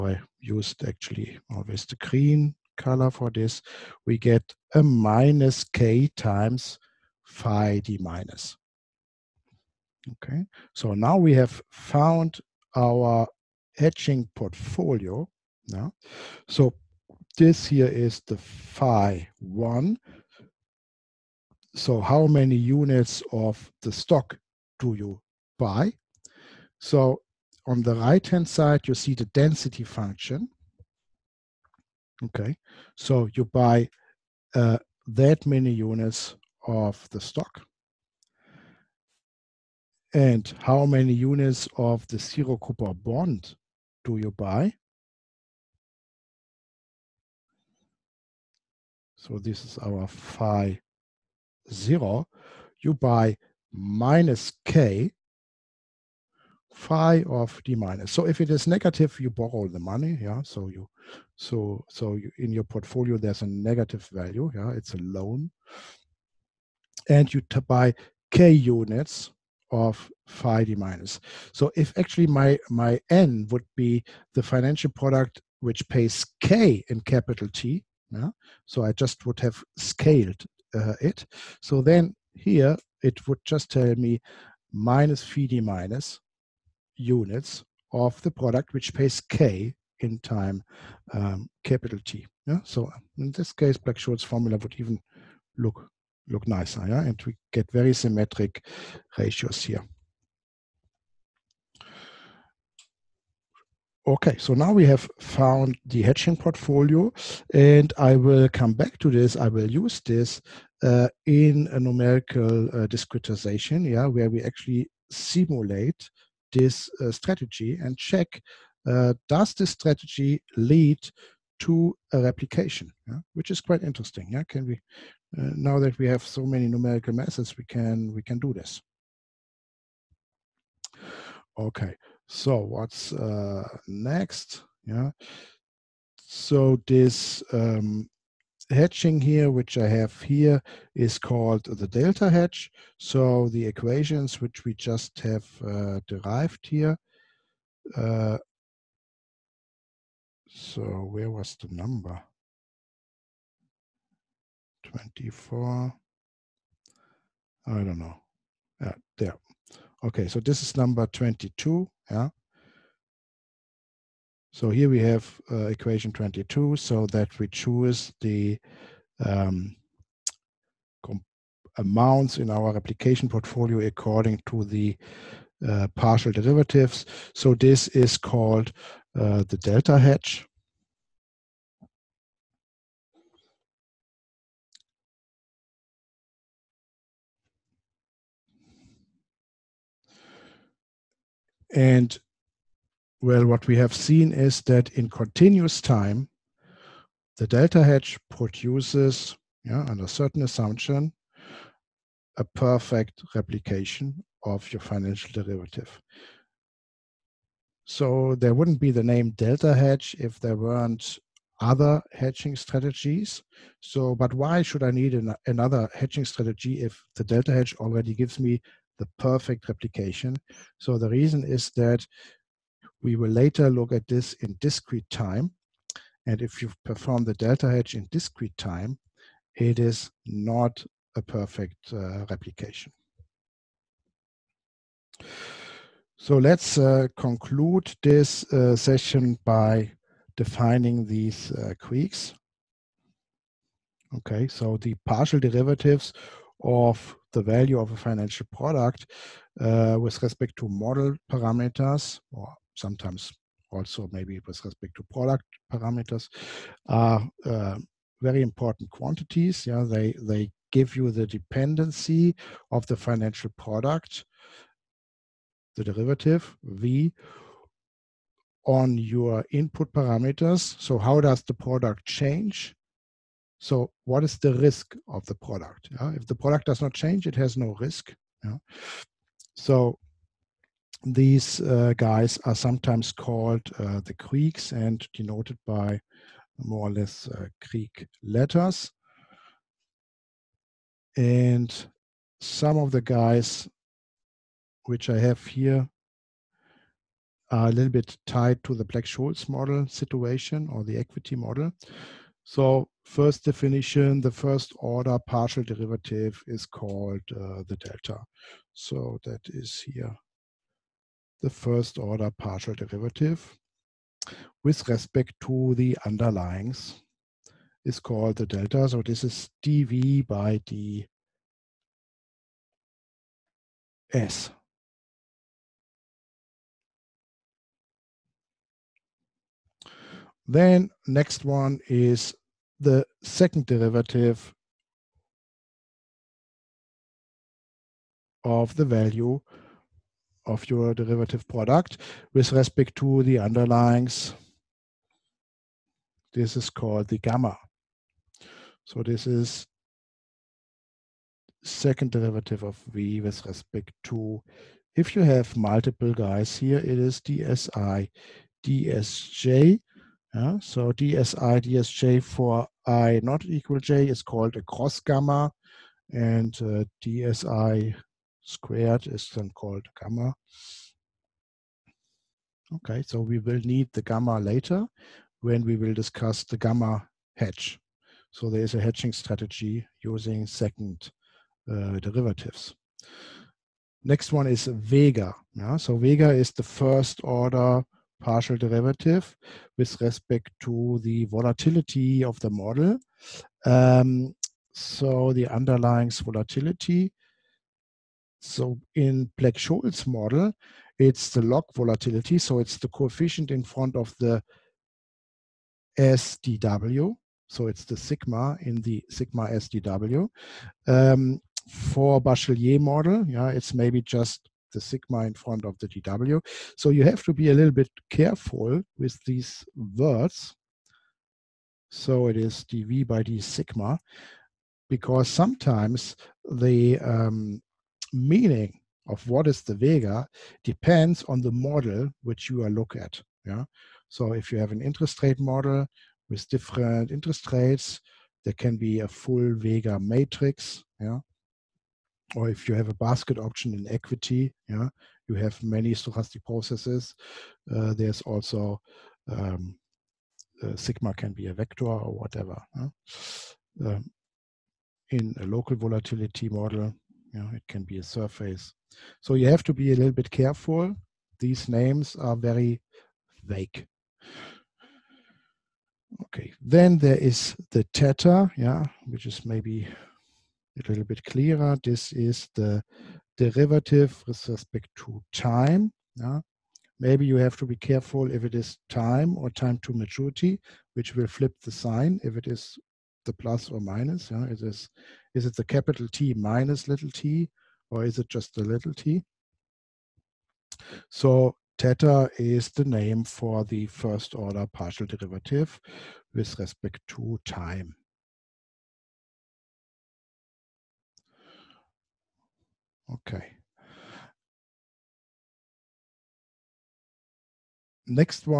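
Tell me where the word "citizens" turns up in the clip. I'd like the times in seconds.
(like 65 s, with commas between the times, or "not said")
not said.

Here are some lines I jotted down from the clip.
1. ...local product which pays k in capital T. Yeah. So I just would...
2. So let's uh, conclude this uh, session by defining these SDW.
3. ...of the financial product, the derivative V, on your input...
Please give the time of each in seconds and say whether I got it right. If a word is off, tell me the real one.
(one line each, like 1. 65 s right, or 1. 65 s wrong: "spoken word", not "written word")
1. 74 s wrong: "financial", not "local"
2. 236 s wrong: "Greeks", not "SDW"
3. 262 s right.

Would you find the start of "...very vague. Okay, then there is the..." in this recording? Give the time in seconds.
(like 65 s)
462 s.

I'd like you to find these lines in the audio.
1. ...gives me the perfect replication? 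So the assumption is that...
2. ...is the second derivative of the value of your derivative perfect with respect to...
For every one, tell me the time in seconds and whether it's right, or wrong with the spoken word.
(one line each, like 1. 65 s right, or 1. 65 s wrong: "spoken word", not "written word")
1. 218 s wrong: "reason", not "assumption"
2. 331 s wrong: "product", not "perfect".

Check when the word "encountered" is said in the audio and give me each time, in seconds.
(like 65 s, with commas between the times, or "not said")
not said.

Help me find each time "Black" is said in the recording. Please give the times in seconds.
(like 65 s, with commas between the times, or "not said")
93 s, 298 s, 399 s.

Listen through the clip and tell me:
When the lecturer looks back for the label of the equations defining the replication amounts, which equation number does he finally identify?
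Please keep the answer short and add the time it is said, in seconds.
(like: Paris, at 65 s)
22, at 160 s.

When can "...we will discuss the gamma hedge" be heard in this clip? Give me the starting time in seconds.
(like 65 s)
375 s.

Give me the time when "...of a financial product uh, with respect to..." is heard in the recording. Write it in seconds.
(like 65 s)
247 s.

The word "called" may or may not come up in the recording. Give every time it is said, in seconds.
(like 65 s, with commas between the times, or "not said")
141 s, 178 s, 283 s, 306 s, 317 s, 346 s, 364 s, 369 s.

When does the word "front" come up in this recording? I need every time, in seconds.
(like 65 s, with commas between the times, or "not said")
403 s, 415 s.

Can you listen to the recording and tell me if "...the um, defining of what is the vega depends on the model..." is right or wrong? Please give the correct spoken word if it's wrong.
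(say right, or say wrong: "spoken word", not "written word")
wrong: "meaning", not "defining".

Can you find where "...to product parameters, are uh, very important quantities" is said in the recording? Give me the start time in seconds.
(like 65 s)
254 s.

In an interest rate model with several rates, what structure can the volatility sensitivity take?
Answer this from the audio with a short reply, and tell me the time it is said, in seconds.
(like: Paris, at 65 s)
a full vega matrix, at 439 s.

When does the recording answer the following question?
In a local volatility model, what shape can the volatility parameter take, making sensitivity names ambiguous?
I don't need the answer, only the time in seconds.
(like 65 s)
457 s.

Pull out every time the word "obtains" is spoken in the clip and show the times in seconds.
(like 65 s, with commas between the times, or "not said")
not said.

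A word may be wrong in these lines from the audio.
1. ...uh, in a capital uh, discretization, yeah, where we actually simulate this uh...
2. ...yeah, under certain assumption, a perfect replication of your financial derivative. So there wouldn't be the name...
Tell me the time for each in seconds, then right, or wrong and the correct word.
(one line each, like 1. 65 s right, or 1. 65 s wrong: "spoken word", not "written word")
1. 110 s wrong: "numerical", not "capital"
2. 199 s right.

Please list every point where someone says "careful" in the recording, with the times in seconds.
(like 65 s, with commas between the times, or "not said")
418 s, 460 s, 477 s.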